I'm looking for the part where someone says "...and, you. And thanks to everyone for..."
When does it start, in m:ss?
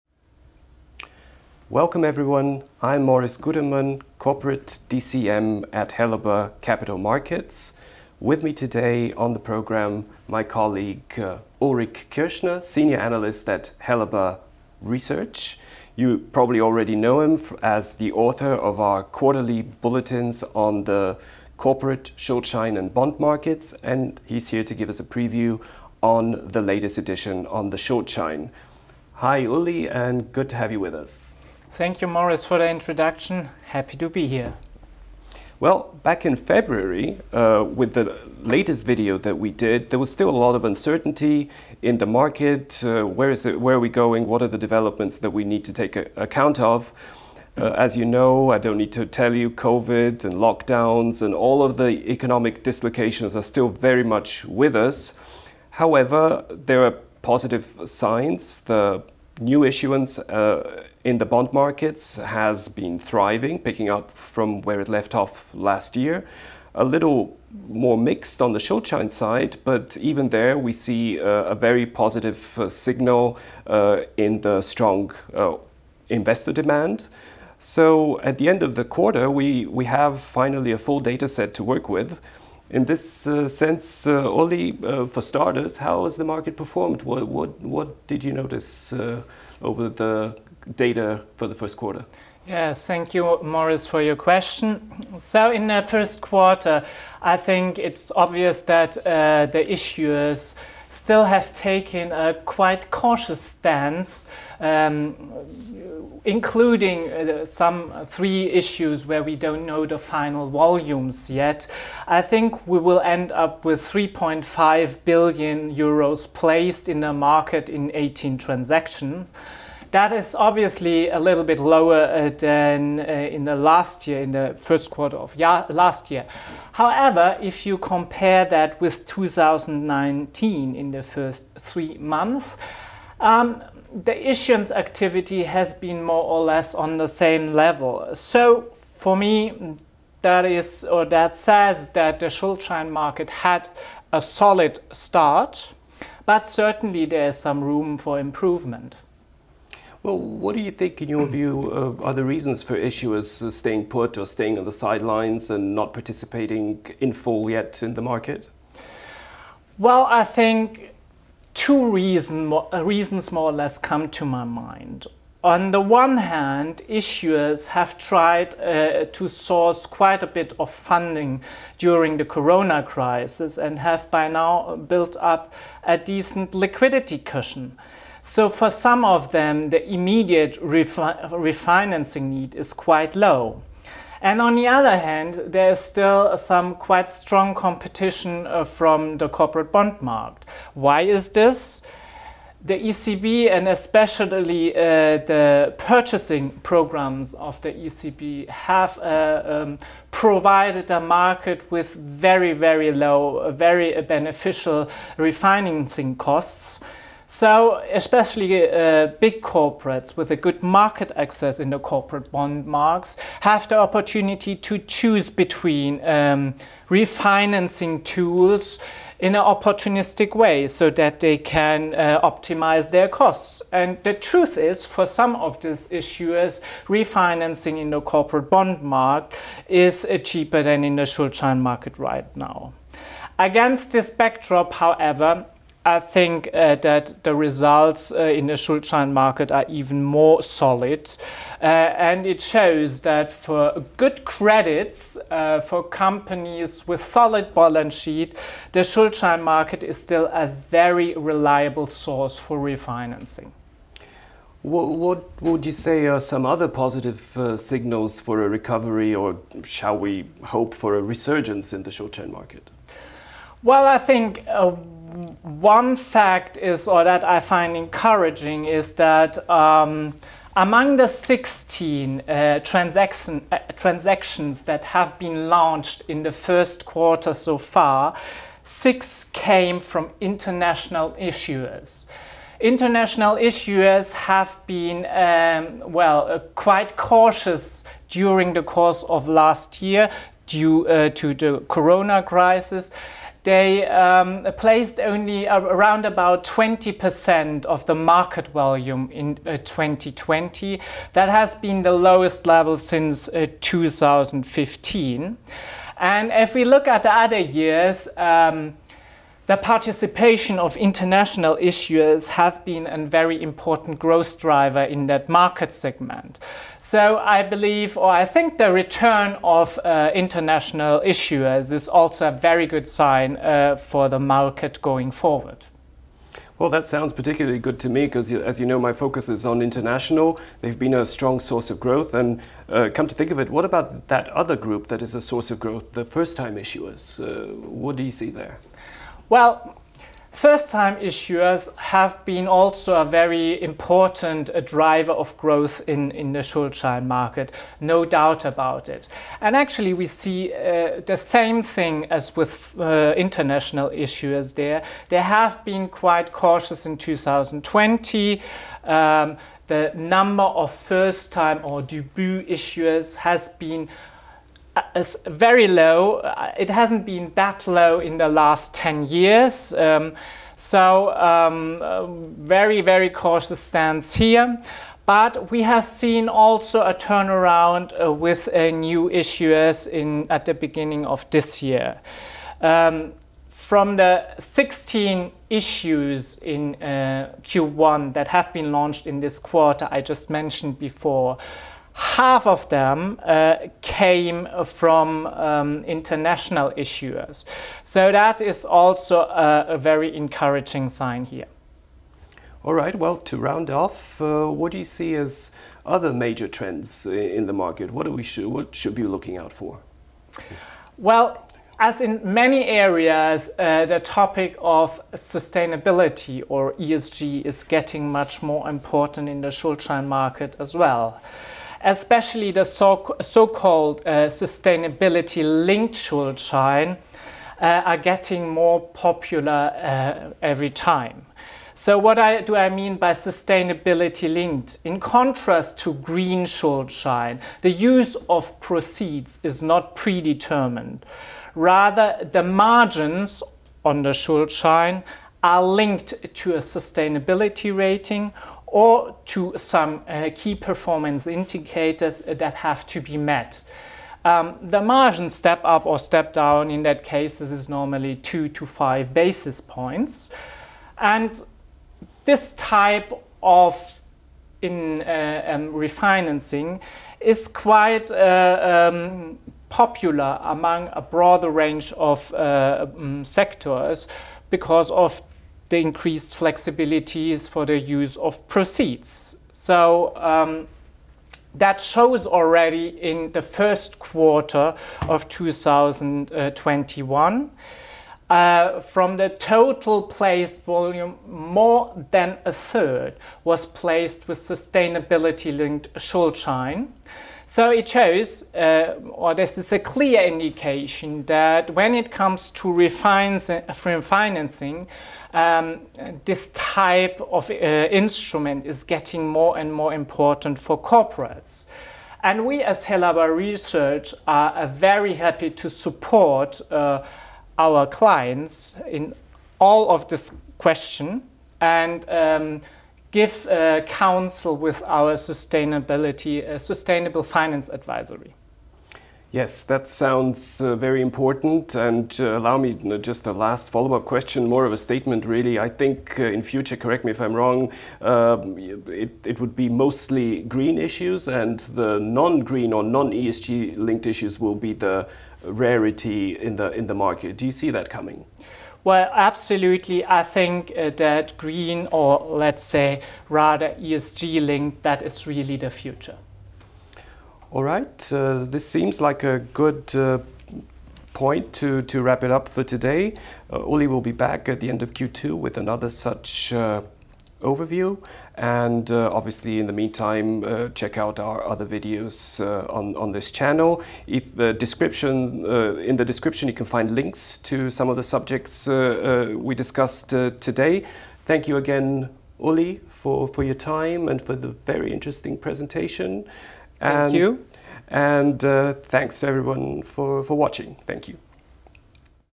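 9:47.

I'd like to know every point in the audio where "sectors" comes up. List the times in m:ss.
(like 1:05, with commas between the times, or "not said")
7:53.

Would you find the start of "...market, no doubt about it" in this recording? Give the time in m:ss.
5:47.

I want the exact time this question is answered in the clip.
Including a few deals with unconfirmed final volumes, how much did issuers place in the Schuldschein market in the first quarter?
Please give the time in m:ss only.
1:53.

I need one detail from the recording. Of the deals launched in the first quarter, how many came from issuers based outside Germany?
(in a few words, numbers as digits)
6.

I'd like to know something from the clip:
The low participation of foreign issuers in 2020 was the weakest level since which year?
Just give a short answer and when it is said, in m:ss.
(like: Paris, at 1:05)
2015, at 5:03.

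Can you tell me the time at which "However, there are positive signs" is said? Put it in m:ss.
0:55.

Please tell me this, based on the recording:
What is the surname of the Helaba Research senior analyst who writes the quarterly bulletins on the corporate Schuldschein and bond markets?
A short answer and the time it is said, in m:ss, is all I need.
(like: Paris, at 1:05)
Kirschner, at 0:11.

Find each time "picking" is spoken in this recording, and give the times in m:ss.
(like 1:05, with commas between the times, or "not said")
1:03.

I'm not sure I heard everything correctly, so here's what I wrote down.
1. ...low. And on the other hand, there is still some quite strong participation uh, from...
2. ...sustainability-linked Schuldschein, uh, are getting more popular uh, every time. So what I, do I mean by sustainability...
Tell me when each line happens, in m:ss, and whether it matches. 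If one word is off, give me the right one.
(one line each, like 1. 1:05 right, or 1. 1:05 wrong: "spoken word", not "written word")
1. 3:03 wrong: "competition", not "participation"
2. 7:04 right.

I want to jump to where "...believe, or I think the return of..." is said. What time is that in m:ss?
5:17.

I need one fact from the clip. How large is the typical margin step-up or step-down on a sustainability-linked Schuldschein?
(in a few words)
2 to 5 basis points.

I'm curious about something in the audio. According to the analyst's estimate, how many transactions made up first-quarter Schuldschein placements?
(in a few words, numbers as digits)
18.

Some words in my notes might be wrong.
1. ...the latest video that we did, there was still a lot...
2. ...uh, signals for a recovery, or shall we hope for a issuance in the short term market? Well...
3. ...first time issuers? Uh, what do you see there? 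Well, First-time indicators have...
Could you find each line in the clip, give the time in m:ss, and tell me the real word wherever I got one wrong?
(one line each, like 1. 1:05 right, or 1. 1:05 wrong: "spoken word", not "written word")
1. 0:37 right
2. 4:17 wrong: "resurgence", not "issuance"
3. 5:36 wrong: "issuers", not "indicators".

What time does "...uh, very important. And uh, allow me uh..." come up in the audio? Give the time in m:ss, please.
8:50.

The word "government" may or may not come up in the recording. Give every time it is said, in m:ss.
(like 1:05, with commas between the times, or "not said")
not said.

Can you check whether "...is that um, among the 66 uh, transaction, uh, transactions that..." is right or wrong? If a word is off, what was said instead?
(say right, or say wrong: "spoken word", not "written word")
wrong: "16", not "66".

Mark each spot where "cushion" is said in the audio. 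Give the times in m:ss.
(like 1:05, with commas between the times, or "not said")
2:57.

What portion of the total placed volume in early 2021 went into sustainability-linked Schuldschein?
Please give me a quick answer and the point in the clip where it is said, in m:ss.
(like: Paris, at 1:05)
More than a third, at 8:11.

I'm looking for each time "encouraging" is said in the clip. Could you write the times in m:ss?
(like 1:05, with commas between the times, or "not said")
4:27, 6:40.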